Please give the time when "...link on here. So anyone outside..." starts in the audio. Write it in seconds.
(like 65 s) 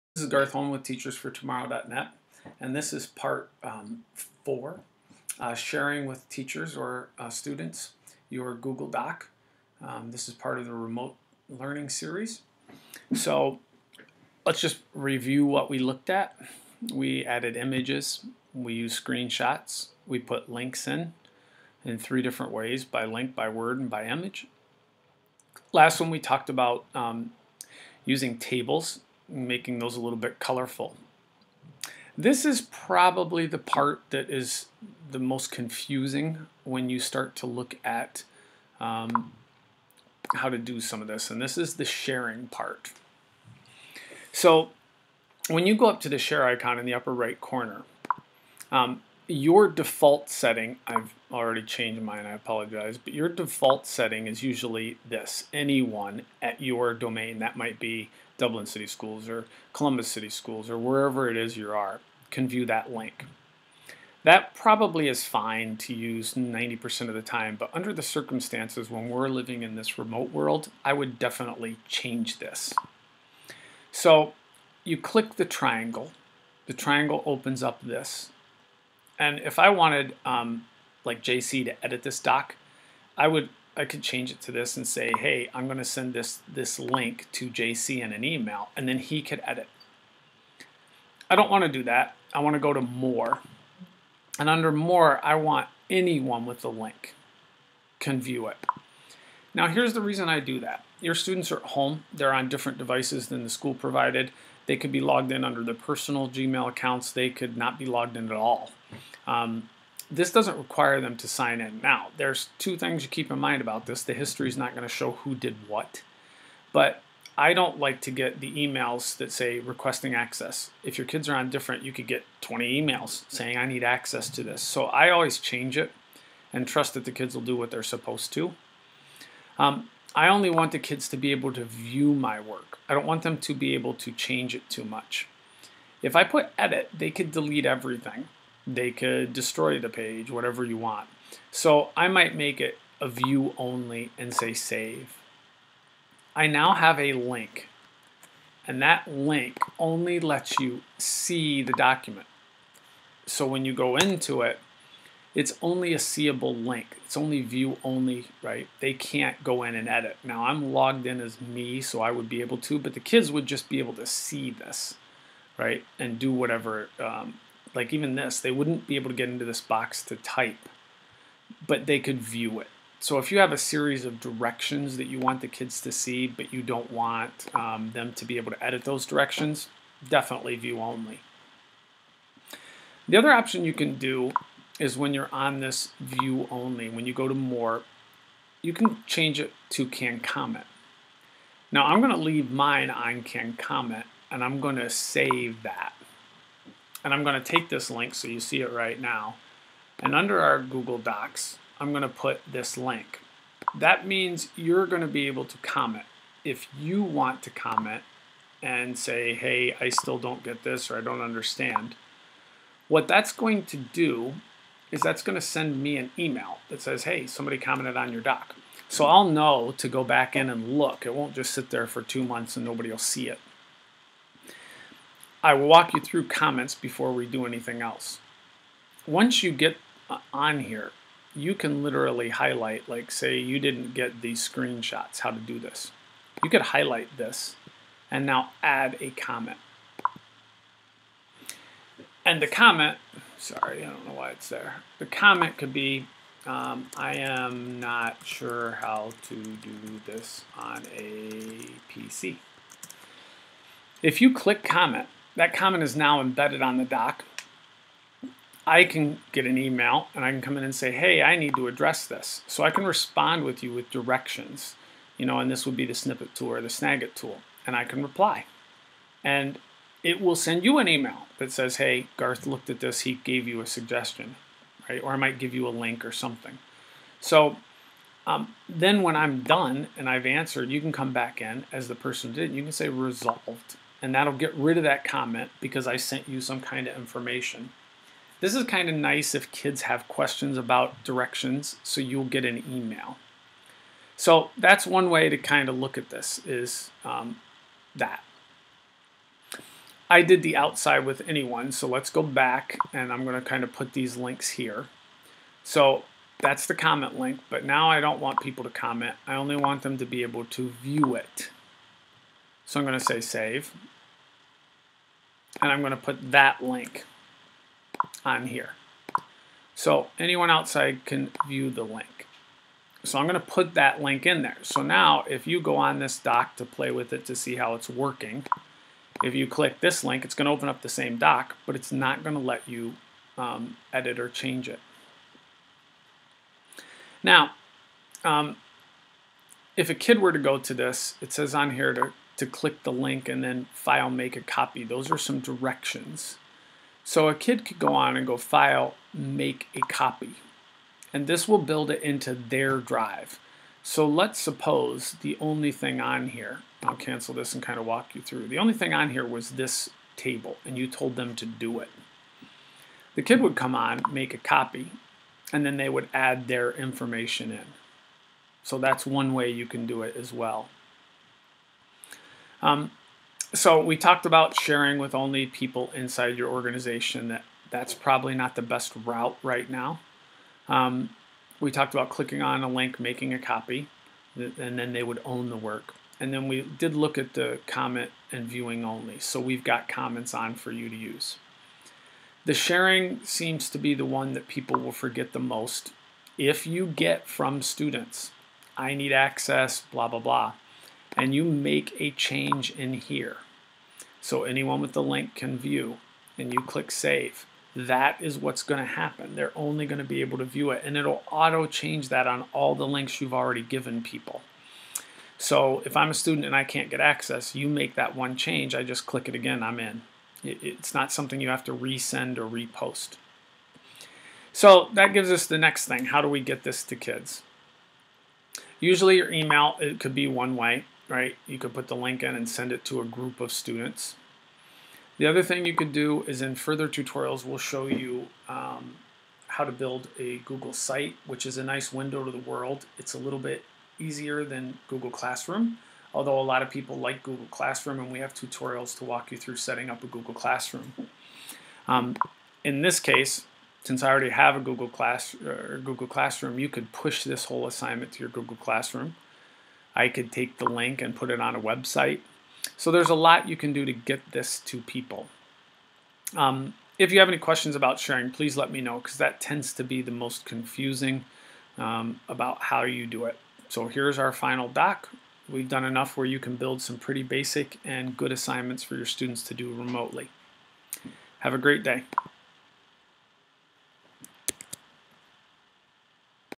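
316 s.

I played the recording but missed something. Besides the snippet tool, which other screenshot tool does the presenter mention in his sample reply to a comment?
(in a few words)
Snagit.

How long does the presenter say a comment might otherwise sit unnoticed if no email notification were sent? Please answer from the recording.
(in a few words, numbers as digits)
two months.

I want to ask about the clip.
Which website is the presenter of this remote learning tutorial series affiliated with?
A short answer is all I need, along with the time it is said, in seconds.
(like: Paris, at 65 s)
TeachersForTomorrow.net, at 0 s.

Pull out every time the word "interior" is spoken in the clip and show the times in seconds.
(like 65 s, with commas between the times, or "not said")
not said.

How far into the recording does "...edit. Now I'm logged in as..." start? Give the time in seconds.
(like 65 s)
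159 s.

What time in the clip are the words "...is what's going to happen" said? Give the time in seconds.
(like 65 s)
408 s.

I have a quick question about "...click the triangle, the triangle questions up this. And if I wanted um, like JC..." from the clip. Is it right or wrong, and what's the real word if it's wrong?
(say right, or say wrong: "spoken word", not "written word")
wrong: "opens", not "questions".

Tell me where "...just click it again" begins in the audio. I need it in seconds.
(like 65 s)
418 s.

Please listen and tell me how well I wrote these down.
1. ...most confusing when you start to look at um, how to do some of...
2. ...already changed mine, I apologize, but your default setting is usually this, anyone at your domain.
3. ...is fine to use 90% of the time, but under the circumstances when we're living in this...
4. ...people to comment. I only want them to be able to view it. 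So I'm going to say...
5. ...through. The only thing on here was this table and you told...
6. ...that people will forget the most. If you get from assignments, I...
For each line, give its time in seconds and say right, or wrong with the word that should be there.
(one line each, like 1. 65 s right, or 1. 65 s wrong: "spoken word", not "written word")
1. 35 s right
2. 51 s right
3. 65 s right
4. 308 s right
5. 358 s right
6. 394 s wrong: "students", not "assignments".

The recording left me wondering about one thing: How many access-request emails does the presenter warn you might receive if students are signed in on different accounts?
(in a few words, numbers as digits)
20.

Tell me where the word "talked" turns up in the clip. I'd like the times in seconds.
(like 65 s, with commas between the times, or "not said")
26 s, 373 s, 381 s.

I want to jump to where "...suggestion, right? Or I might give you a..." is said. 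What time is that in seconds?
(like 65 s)
273 s.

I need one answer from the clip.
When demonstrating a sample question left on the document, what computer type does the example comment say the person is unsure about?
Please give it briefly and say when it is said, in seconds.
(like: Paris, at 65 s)
a PC, at 250 s.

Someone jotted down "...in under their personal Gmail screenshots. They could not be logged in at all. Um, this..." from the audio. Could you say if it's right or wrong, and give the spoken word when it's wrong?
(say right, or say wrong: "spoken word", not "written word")
wrong: "accounts", not "screenshots".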